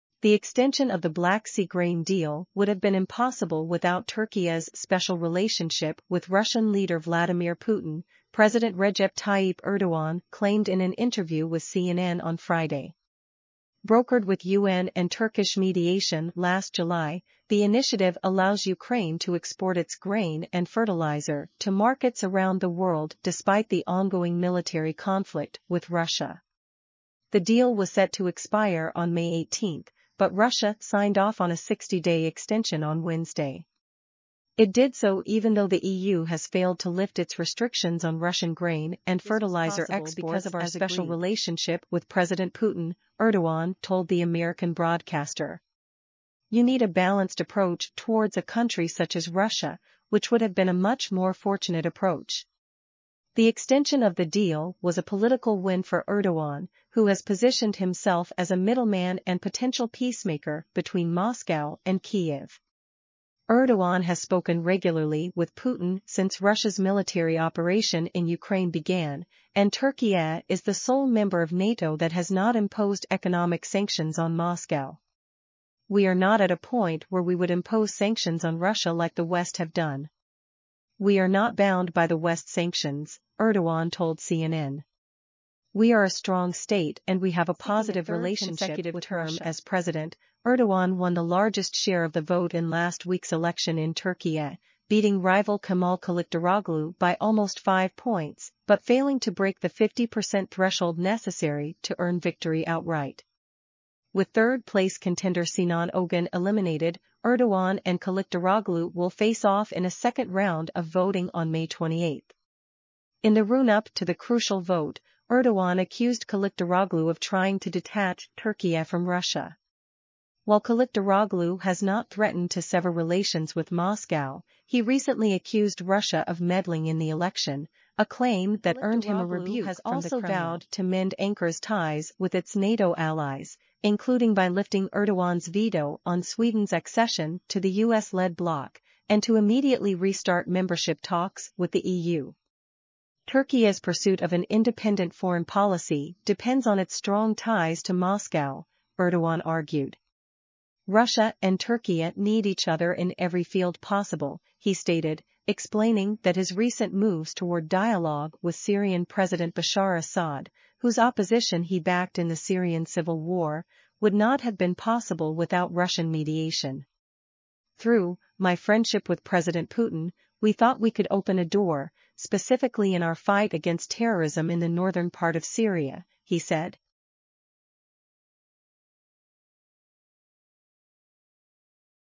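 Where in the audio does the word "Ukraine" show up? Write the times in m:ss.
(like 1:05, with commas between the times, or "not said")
0:18, 1:08.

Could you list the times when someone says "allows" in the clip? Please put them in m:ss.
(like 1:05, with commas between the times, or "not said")
0:18.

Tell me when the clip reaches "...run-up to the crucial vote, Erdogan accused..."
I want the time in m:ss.
1:53.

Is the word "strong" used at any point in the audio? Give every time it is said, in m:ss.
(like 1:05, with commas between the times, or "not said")
1:26, 2:26.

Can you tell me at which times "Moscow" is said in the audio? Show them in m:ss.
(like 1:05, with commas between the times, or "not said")
1:01, 1:14, 2:03, 2:27.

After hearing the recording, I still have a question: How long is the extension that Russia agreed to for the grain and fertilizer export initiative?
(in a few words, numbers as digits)
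60 days.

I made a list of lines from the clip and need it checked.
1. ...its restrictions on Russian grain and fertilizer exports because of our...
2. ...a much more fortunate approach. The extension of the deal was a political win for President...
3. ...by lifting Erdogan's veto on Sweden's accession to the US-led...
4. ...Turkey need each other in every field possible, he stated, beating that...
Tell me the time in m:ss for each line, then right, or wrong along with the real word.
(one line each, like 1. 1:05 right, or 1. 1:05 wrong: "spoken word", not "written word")
1. 0:37 right
2. 0:50 wrong: "Erdogan", not "President"
3. 2:14 right
4. 2:31 wrong: "explaining", not "beating".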